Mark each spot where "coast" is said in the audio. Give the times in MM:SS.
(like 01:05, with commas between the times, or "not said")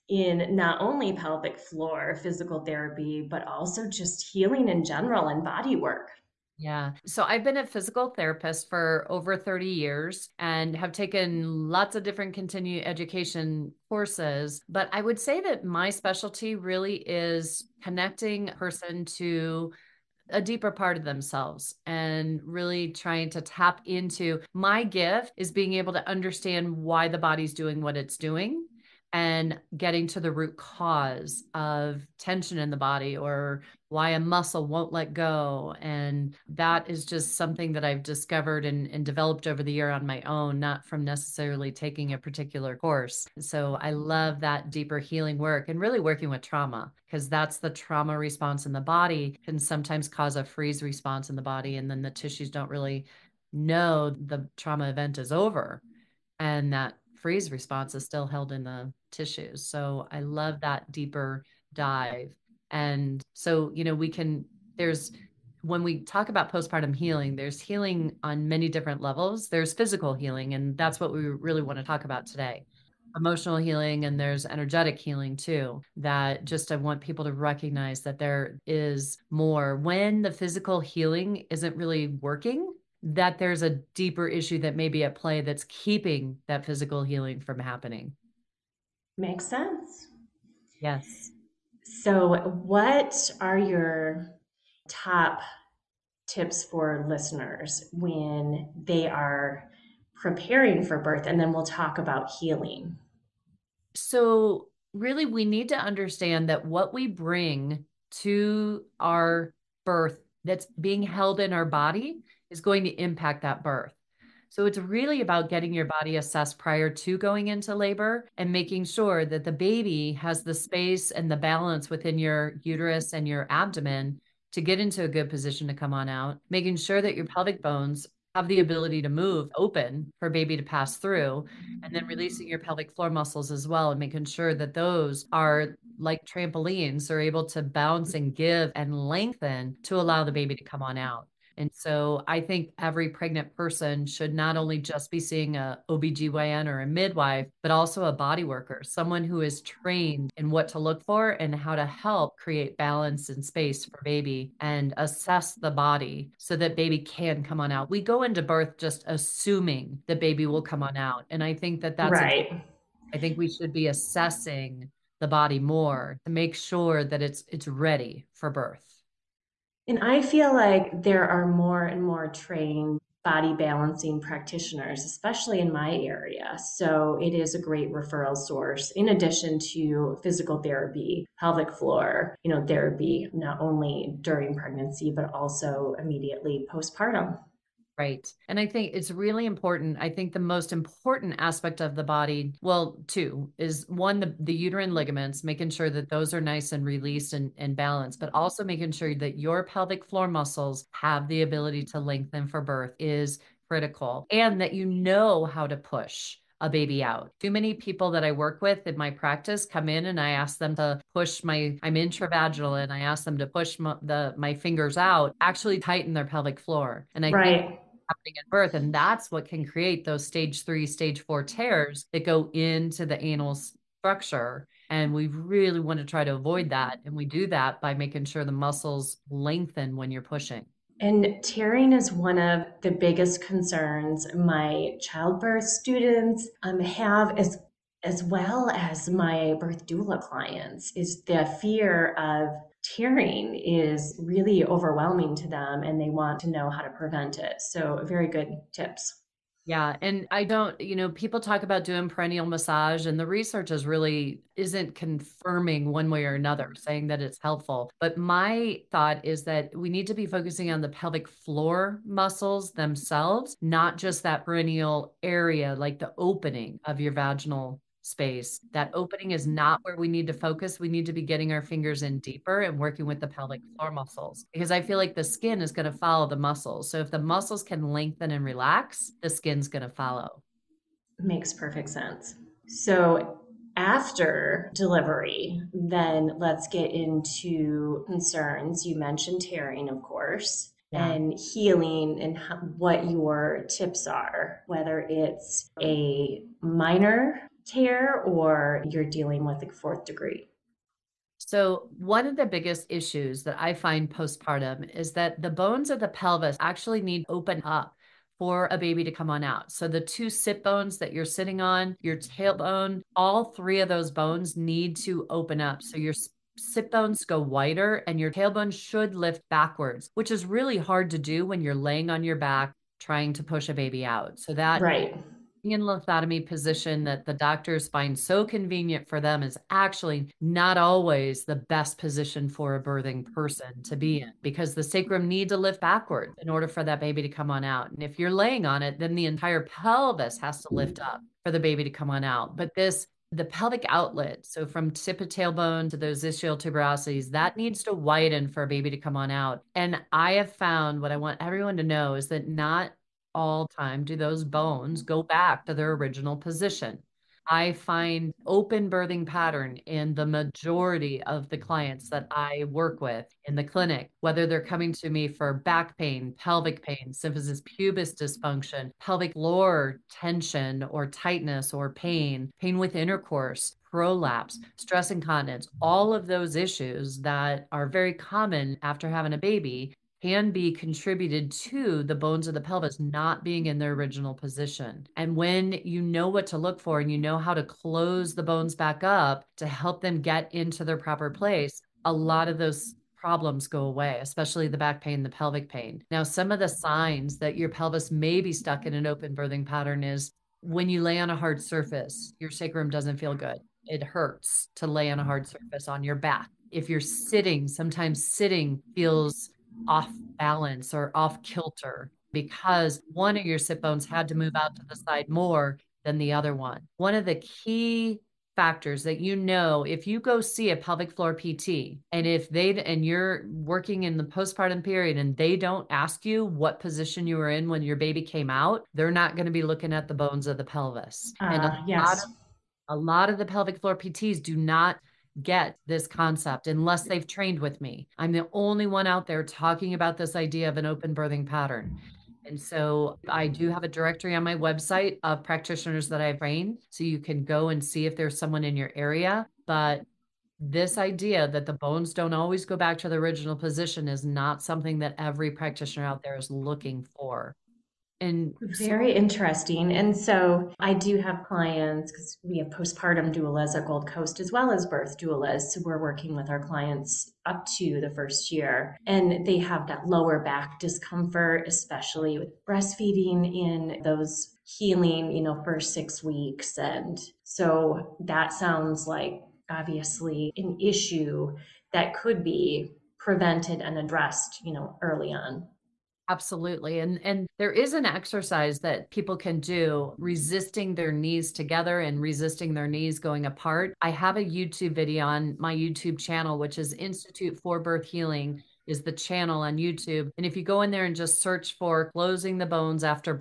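07:44.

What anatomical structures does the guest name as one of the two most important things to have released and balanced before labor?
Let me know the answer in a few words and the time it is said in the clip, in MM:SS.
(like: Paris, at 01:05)
uterine ligaments, at 03:14.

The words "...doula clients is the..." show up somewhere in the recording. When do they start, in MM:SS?
03:59.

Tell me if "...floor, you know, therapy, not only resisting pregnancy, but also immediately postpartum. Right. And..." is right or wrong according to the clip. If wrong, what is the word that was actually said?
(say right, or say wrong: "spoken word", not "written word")
wrong: "during", not "resisting".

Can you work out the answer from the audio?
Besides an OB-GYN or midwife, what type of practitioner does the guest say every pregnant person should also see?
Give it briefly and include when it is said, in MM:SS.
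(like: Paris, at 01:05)
a body worker, at 02:28.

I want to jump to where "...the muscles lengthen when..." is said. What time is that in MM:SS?
03:48.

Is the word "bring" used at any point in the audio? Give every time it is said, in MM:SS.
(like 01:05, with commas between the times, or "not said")
01:47.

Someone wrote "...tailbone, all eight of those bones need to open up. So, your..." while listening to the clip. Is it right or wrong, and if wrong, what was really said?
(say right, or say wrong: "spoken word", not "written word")
wrong: "three", not "eight".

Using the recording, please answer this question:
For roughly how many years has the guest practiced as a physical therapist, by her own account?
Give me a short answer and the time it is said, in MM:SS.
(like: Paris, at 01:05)
over 30 years, at 00:09.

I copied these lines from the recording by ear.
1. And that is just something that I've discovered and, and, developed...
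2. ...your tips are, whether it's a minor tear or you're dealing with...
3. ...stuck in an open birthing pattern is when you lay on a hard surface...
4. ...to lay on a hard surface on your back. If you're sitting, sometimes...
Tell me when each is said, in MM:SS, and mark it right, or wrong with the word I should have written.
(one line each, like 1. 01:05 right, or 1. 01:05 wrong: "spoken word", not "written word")
1. 00:35 right
2. 04:53 right
3. 06:38 right
4. 06:44 right.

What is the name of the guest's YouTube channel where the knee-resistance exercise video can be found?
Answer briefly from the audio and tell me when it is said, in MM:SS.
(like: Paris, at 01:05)
Institute for Birth Healing, at 08:16.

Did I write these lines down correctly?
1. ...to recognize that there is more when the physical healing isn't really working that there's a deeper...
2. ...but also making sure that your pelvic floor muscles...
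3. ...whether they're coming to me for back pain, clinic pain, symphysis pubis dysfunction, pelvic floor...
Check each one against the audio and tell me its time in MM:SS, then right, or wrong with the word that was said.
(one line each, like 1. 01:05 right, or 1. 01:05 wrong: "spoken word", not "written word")
1. 01:17 right
2. 03:18 right
3. 06:04 wrong: "pelvic", not "clinic".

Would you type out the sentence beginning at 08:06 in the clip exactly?
And and there is an exercise that people can do resisting their knees together and resisting their knees going apart.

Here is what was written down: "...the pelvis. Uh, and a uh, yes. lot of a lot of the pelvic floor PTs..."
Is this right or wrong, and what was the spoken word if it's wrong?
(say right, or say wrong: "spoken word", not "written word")
right.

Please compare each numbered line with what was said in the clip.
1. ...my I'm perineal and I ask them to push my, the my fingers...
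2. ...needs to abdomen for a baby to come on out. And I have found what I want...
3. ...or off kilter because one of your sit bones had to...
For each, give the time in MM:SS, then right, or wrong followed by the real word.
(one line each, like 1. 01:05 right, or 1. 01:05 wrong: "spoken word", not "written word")
1. 03:31 wrong: "intravaginal", not "perineal"
2. 05:47 wrong: "widen", not "abdomen"
3. 06:50 right.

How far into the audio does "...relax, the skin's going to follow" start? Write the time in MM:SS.
04:38.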